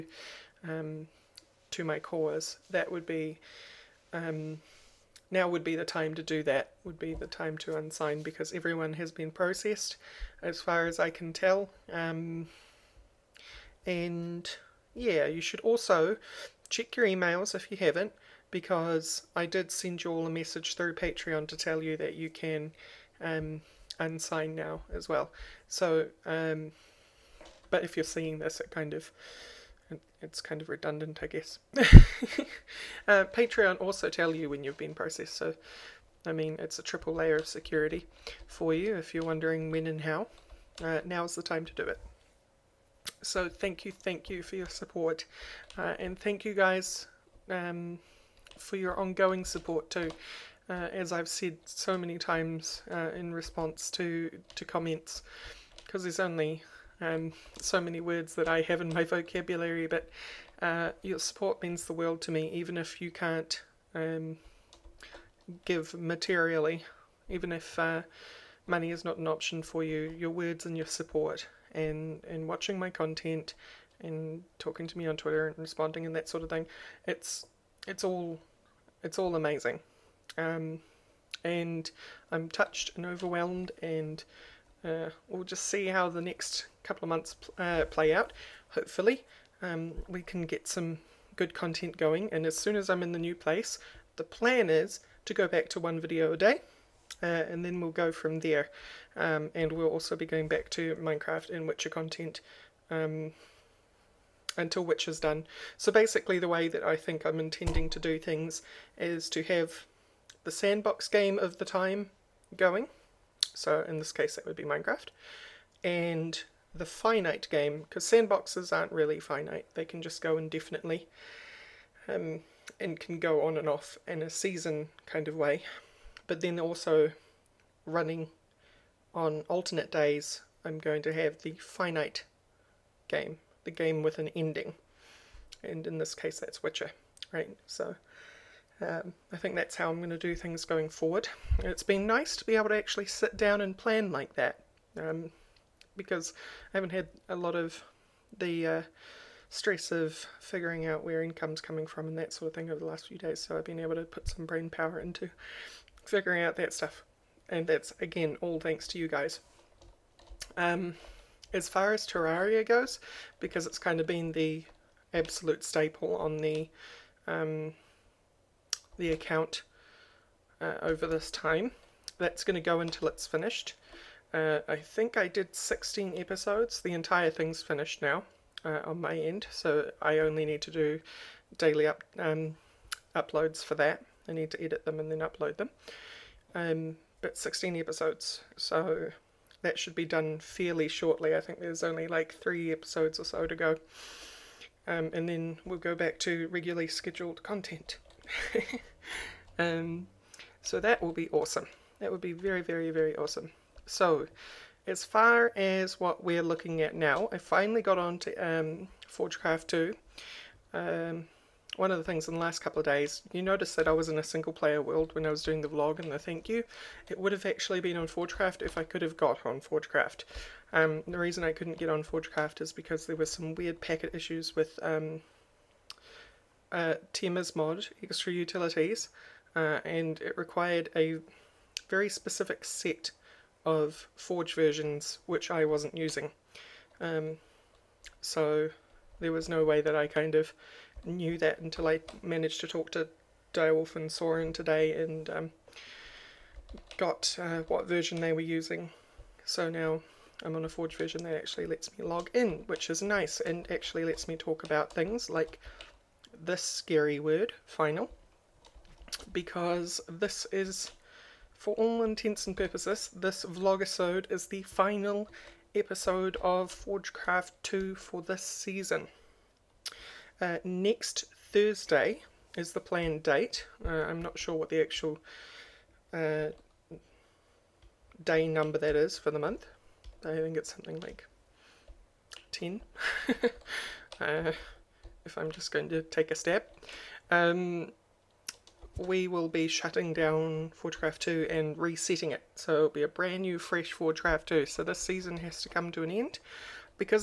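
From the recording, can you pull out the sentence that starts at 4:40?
I think it's something like 10.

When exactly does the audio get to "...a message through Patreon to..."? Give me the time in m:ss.
0:20.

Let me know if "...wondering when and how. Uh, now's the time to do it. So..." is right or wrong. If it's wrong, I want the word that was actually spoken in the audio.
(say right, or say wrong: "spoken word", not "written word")
right.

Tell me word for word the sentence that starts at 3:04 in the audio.
I need to edit them and then upload them.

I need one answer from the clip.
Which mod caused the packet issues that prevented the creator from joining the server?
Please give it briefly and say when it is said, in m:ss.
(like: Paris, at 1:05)
Extra Utilities, at 3:48.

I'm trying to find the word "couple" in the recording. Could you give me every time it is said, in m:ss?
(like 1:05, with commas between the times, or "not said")
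1:26, 3:32.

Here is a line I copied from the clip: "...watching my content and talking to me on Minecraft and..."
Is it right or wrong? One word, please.
wrong.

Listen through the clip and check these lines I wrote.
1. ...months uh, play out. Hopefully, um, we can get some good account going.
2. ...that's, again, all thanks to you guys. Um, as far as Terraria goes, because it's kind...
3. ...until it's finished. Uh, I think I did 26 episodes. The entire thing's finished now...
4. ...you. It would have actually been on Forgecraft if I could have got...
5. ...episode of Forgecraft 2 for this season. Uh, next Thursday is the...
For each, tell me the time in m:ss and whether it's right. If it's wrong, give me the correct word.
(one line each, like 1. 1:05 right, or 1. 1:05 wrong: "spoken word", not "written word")
1. 1:27 wrong: "content", not "account"
2. 2:37 right
3. 2:52 wrong: "16", not "26"
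4. 3:36 right
5. 4:25 right.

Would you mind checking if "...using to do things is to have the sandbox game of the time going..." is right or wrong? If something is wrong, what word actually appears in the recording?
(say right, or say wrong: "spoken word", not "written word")
wrong: "intending", not "using".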